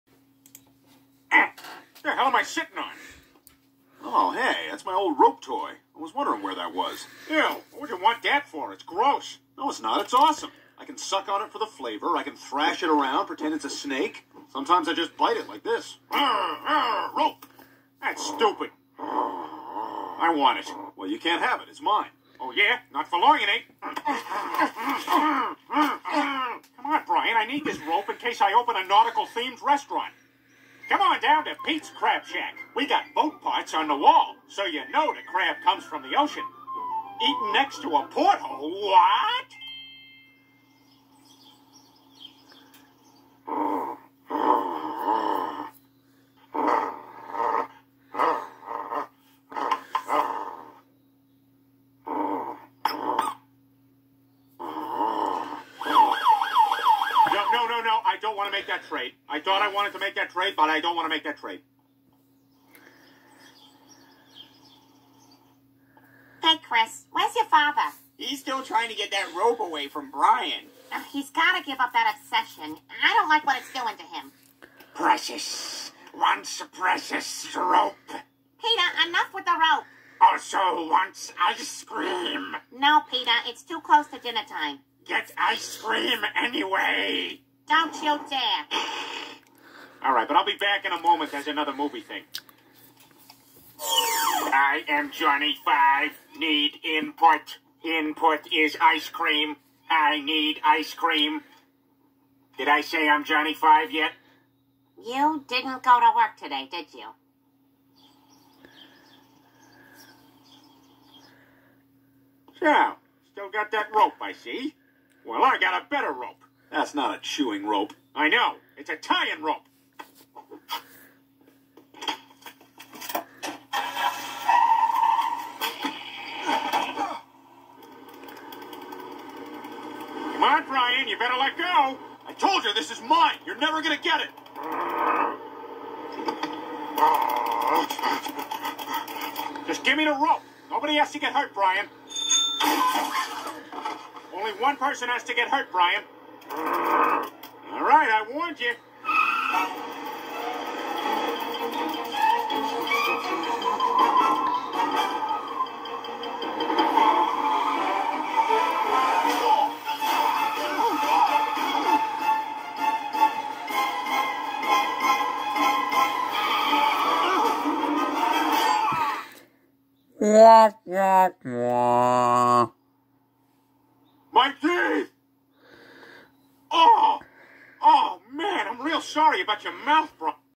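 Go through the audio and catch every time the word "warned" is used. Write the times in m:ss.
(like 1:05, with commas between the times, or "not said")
2:28.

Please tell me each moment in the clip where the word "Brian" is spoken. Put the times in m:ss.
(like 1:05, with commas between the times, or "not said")
0:27, 1:10, 2:10, 2:21, 2:25.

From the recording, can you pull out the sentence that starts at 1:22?
No, Peter, it's too close to dinner time.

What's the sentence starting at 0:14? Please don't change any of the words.
Sometimes I just bite it like this.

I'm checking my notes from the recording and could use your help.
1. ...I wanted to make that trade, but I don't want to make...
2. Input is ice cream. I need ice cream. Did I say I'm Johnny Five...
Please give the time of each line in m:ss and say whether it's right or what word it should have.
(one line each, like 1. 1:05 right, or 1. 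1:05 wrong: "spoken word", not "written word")
1. 0:59 right
2. 1:37 right.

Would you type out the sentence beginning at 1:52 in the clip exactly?
So, still got that rope, I see.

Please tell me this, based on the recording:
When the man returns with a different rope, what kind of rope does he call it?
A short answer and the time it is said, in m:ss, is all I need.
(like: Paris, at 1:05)
tying rope, at 1:58.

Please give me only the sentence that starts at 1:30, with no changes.
All right, but I'll be back in a moment.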